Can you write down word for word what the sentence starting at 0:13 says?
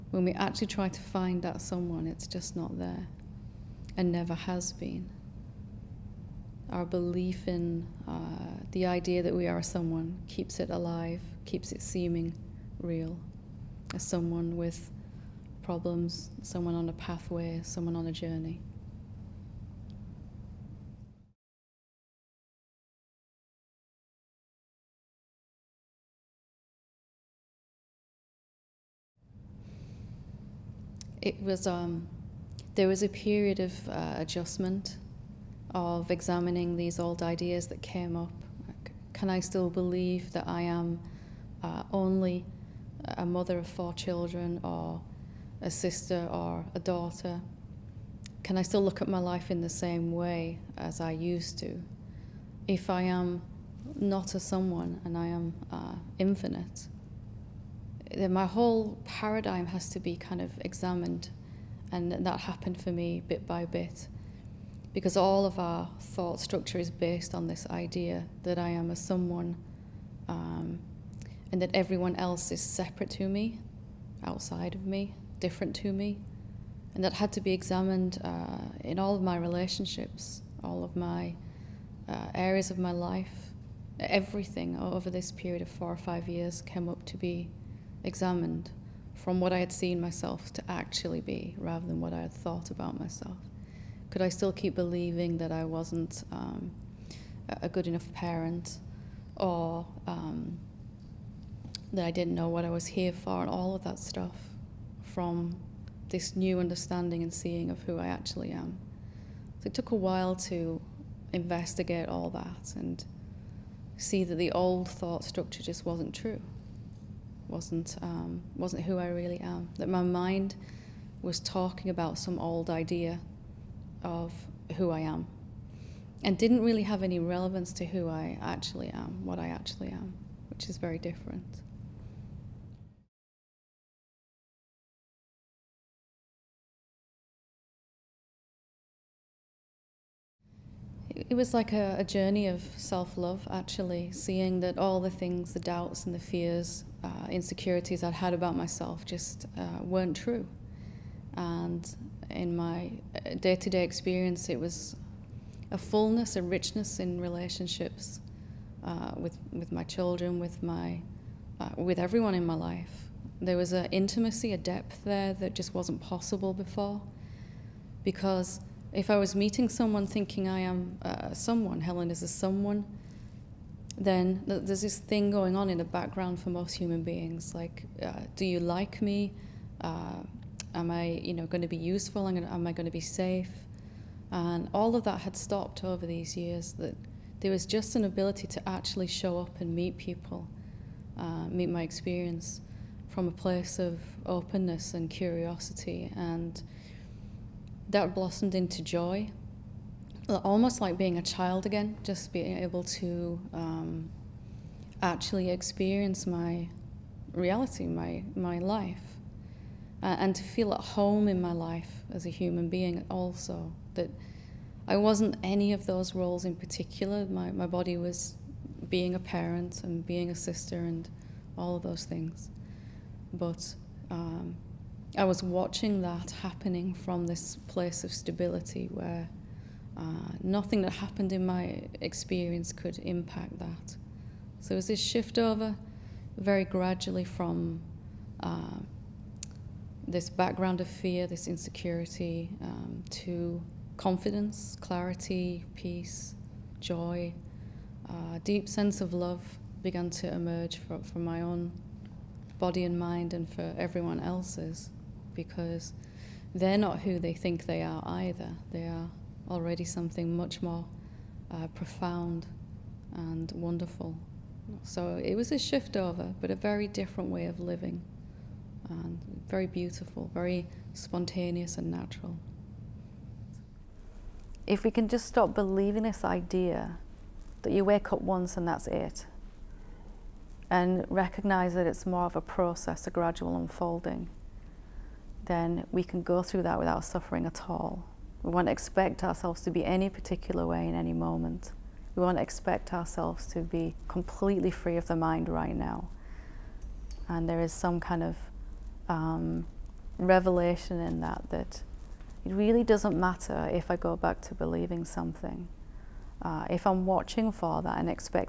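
As someone with problems, someone on a pathway, someone on a journey.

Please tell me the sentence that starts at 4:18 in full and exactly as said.
They are already something much more uh, profound and wonderful.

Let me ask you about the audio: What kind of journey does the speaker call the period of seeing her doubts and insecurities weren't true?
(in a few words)
Self love.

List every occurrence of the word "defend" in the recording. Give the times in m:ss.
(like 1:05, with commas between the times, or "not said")
not said.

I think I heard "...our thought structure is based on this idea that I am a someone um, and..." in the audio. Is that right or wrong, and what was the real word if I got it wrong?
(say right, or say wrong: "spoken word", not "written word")
right.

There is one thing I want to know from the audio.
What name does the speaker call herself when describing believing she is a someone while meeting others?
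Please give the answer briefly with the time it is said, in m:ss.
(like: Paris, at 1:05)
Helen, at 2:51.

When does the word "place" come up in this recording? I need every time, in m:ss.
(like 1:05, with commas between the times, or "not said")
3:13, 3:47.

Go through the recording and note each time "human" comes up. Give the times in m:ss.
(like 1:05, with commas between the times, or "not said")
2:56, 3:32.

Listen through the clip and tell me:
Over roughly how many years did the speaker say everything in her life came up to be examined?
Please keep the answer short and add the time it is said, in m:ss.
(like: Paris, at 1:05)
4 or 5 years, at 1:25.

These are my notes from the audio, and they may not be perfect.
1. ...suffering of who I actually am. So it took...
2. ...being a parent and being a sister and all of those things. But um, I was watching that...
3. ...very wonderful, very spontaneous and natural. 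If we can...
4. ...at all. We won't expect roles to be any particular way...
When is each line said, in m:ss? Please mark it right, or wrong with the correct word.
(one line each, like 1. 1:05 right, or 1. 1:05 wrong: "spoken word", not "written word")
1. 1:47 wrong: "seeing", not "suffering"
2. 3:38 right
3. 4:29 wrong: "beautiful", not "wonderful"
4. 4:47 wrong: "ourselves", not "roles".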